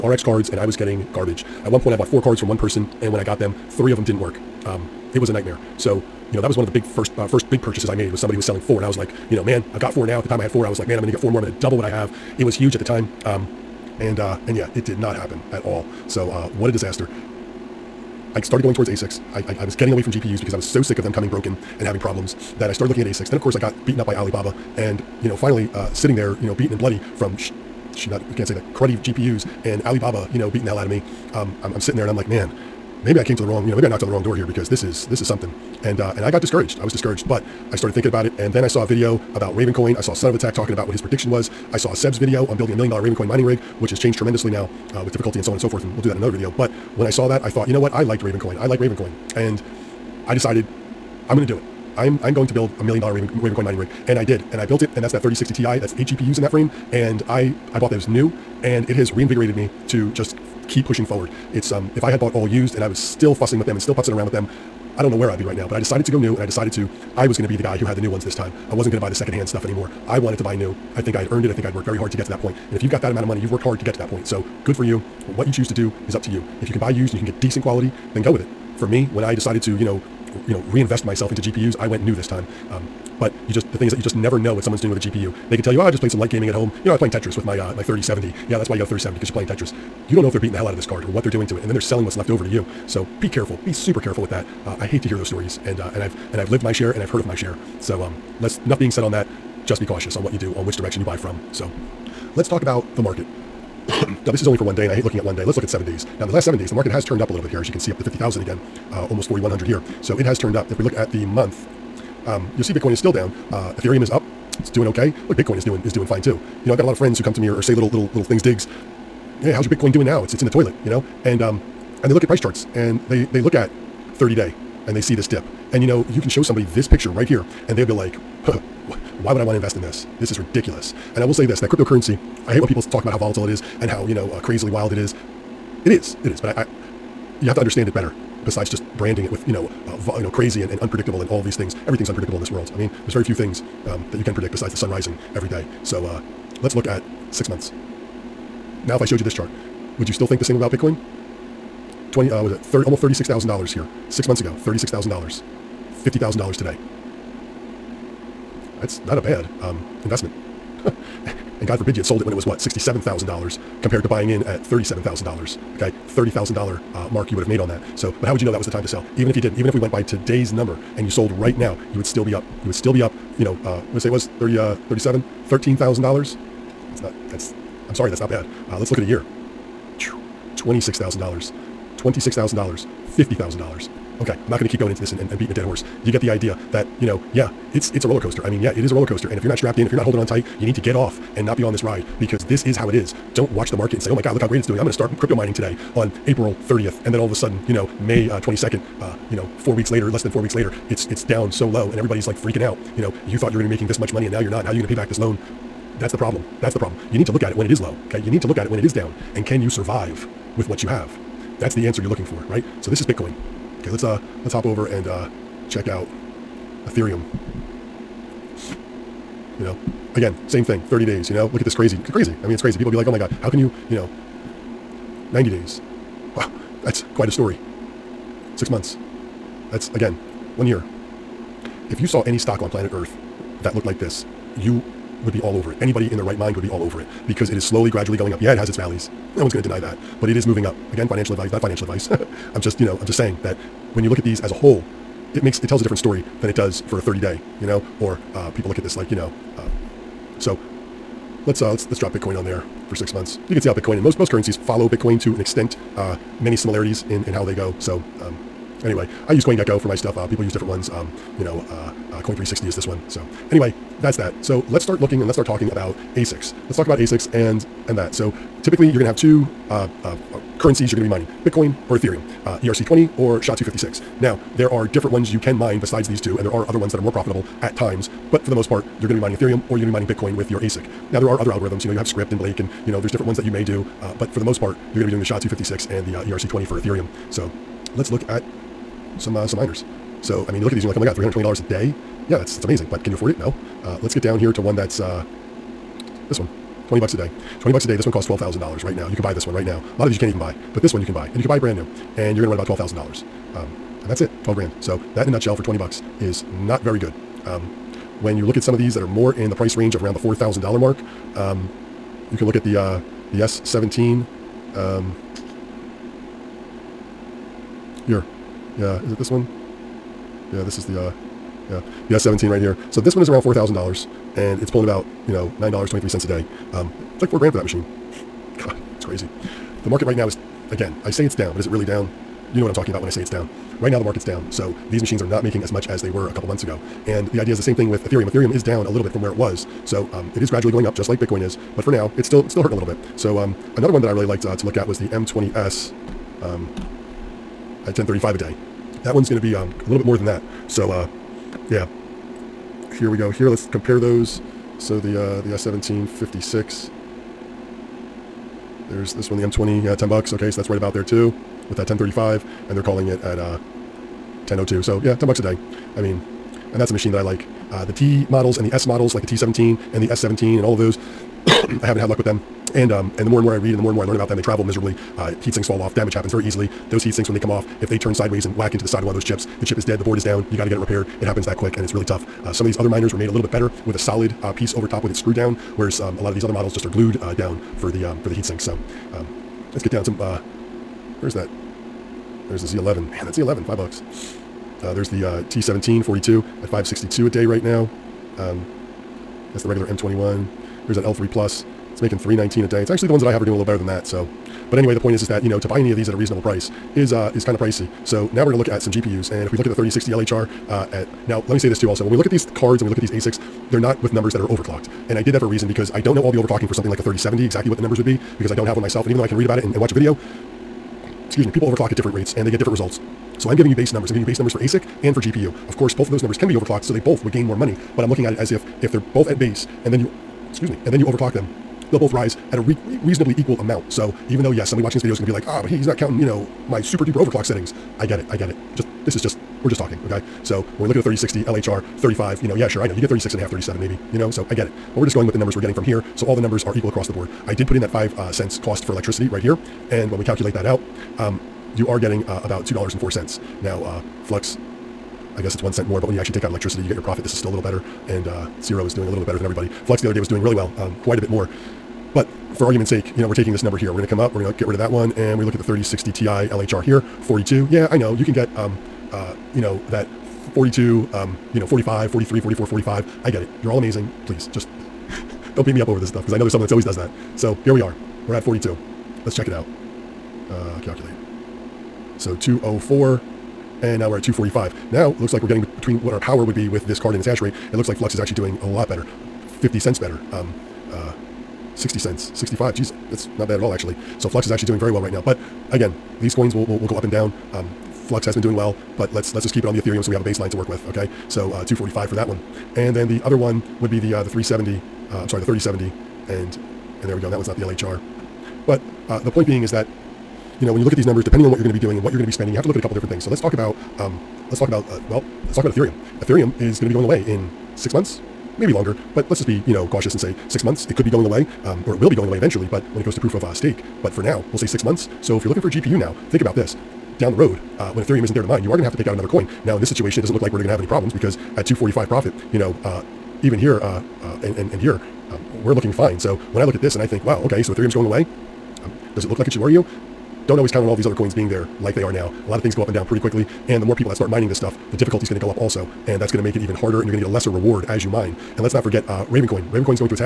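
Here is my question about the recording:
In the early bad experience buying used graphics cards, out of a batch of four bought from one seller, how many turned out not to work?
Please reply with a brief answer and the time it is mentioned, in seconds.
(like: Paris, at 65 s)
3, at 3 s.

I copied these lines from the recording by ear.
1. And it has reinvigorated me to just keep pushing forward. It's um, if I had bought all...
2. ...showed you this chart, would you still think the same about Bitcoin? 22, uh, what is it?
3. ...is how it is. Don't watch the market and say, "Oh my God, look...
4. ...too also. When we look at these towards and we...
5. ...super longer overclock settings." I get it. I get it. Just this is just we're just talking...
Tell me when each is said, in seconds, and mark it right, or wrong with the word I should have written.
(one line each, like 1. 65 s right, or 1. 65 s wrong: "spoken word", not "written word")
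1. 58 s right
2. 149 s wrong: "20", not "22"
3. 192 s right
4. 411 s wrong: "cards", not "towards"
5. 436 s wrong: "duper", not "longer".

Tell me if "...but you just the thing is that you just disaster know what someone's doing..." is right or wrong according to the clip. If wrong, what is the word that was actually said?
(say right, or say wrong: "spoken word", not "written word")
wrong: "never", not "disaster".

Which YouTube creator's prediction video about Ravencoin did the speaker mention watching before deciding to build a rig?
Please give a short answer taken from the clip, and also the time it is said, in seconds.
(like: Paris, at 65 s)
Son of a Tech, at 40 s.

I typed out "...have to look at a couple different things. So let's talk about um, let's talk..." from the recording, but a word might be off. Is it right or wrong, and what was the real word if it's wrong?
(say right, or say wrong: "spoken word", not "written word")
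right.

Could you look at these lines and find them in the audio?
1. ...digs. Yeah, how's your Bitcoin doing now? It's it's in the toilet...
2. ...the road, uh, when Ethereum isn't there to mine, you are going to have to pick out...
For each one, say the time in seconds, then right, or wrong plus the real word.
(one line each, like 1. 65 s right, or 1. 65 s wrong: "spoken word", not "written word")
1. 118 s right
2. 527 s right.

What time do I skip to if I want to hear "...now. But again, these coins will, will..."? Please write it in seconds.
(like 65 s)
495 s.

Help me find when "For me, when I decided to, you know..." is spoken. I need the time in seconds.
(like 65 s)
78 s.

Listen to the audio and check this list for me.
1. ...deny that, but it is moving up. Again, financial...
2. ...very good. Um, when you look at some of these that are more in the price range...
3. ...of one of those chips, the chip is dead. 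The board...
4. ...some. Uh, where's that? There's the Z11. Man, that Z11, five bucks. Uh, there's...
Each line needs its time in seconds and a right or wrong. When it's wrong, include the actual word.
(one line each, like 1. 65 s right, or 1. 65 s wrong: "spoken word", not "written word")
1. 239 s right
2. 306 s right
3. 379 s right
4. 390 s right.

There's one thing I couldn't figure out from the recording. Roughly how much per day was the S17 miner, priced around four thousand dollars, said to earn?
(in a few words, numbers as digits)
$9.23.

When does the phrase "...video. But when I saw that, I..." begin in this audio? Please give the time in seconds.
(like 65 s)
46 s.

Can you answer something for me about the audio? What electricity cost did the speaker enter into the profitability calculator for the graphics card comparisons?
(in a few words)
5 cents.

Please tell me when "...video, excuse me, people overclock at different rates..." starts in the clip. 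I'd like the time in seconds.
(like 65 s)
419 s.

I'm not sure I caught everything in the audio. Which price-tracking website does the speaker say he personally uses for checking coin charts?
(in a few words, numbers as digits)
CoinGecko.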